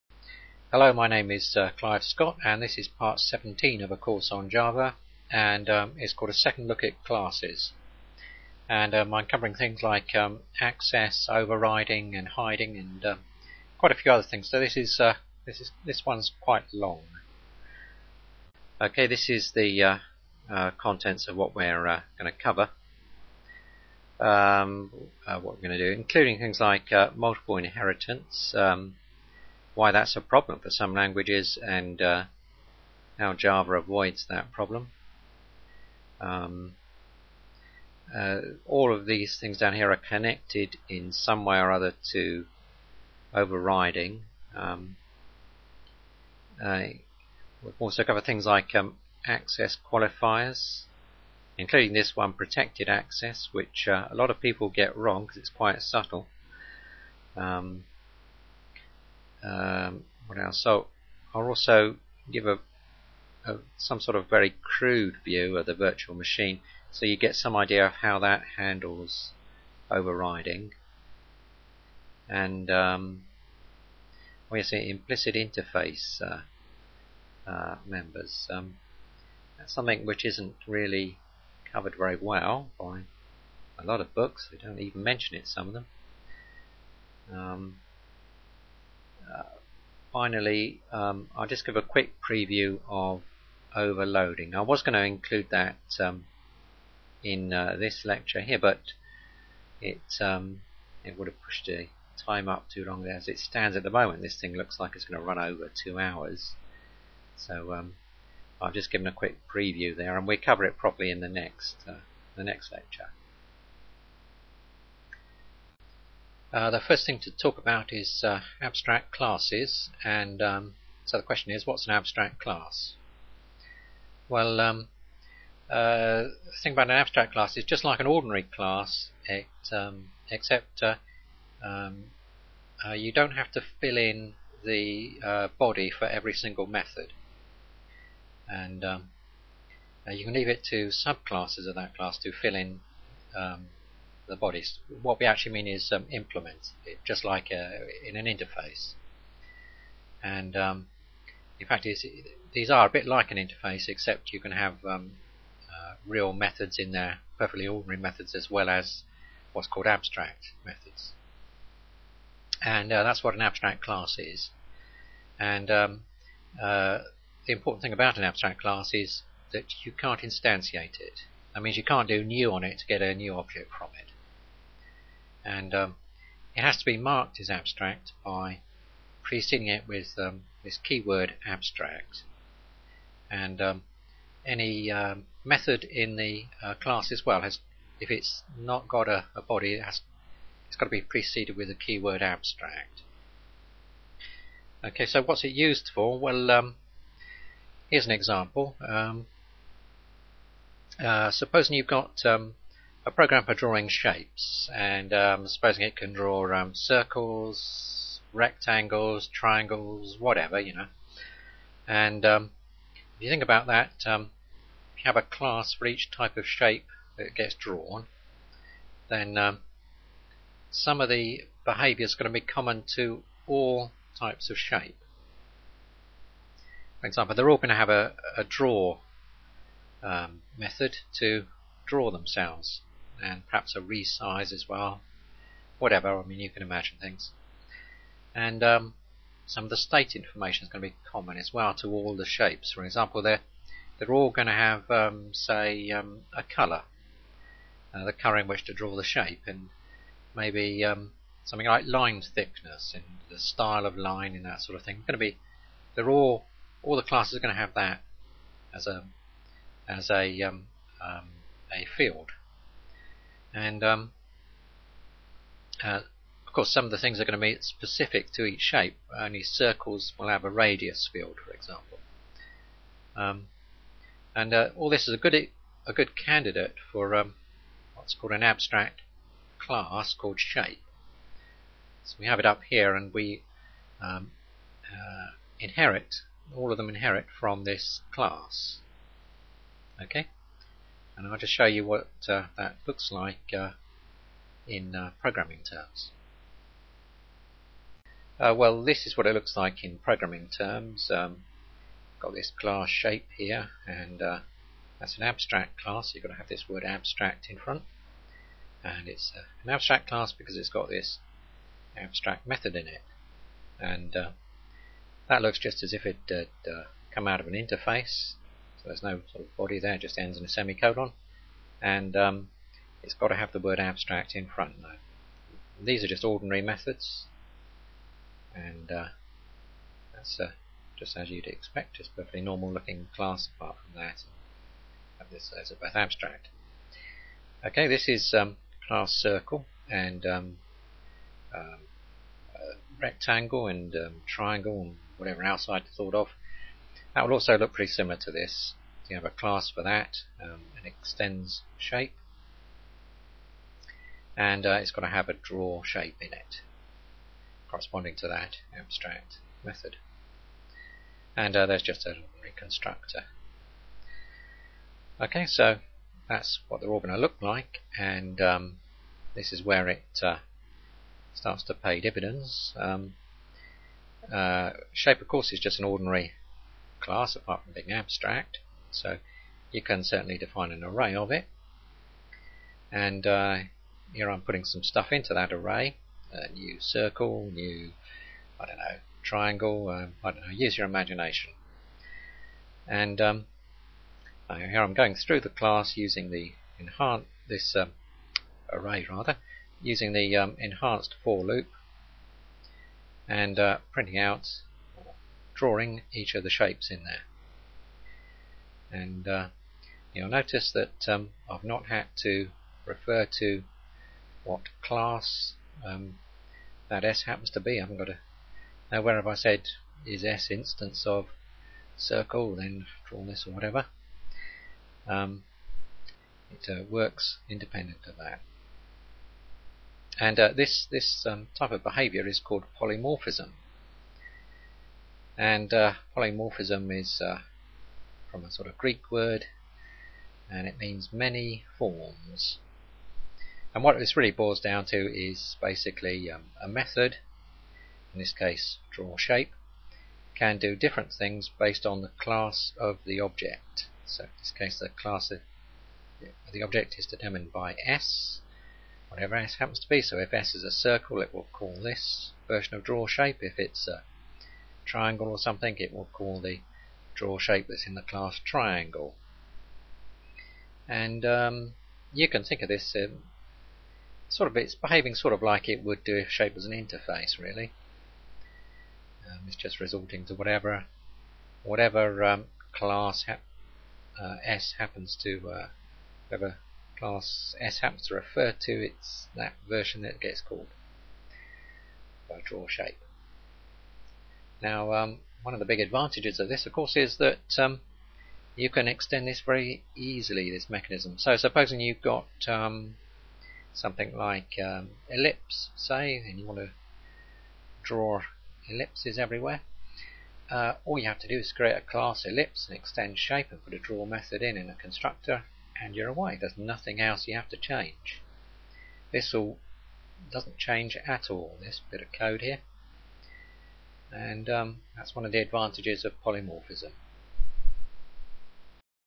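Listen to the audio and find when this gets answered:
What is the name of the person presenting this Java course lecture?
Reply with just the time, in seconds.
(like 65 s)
1 s.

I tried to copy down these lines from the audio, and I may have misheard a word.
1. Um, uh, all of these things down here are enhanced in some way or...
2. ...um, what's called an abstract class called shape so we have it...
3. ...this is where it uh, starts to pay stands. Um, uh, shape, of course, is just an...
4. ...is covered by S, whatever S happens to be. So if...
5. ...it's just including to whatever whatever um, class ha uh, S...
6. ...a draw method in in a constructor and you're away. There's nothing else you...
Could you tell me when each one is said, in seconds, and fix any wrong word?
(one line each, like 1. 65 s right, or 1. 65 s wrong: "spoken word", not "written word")
1. 36 s wrong: "connected", not "enhanced"
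2. 277 s right
3. 369 s wrong: "dividends", not "stands"
4. 456 s wrong: "determined", not "covered"
5. 479 s wrong: "resorting", not "including"
6. 513 s right.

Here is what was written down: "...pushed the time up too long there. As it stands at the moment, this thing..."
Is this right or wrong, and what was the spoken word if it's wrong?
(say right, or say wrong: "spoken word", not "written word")
right.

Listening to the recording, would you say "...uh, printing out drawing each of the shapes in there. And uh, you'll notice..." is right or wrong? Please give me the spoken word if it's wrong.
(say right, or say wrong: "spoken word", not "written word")
right.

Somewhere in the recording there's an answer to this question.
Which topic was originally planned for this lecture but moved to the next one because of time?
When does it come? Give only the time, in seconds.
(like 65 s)
93 s.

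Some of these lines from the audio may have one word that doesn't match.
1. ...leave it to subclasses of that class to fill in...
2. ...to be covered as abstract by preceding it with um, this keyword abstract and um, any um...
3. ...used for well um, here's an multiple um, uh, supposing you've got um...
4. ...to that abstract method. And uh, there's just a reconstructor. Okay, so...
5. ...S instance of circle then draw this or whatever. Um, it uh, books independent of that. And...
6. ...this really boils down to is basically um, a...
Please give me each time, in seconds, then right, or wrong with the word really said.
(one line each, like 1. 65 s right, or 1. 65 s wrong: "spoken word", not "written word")
1. 140 s right
2. 176 s wrong: "marked", not "covered"
3. 195 s wrong: "example", not "multiple"
4. 358 s right
5. 420 s wrong: "works", not "books"
6. 443 s right.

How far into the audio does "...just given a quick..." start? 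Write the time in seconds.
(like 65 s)
108 s.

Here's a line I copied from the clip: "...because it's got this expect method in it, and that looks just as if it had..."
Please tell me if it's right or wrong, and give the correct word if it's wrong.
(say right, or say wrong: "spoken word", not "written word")
wrong: "abstract", not "expect".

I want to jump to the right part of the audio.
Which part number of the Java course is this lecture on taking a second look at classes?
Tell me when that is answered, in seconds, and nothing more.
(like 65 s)
2 s.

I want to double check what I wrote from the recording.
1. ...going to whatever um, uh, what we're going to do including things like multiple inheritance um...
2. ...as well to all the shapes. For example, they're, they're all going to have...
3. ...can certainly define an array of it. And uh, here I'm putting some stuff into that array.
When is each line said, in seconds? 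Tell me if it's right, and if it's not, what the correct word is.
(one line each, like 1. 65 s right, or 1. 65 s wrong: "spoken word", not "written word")
1. 22 s wrong: "cover", not "whatever"
2. 241 s right
3. 379 s right.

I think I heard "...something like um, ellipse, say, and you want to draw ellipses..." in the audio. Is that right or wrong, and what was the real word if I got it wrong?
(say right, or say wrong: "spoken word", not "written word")
right.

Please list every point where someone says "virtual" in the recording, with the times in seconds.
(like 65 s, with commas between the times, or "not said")
65 s.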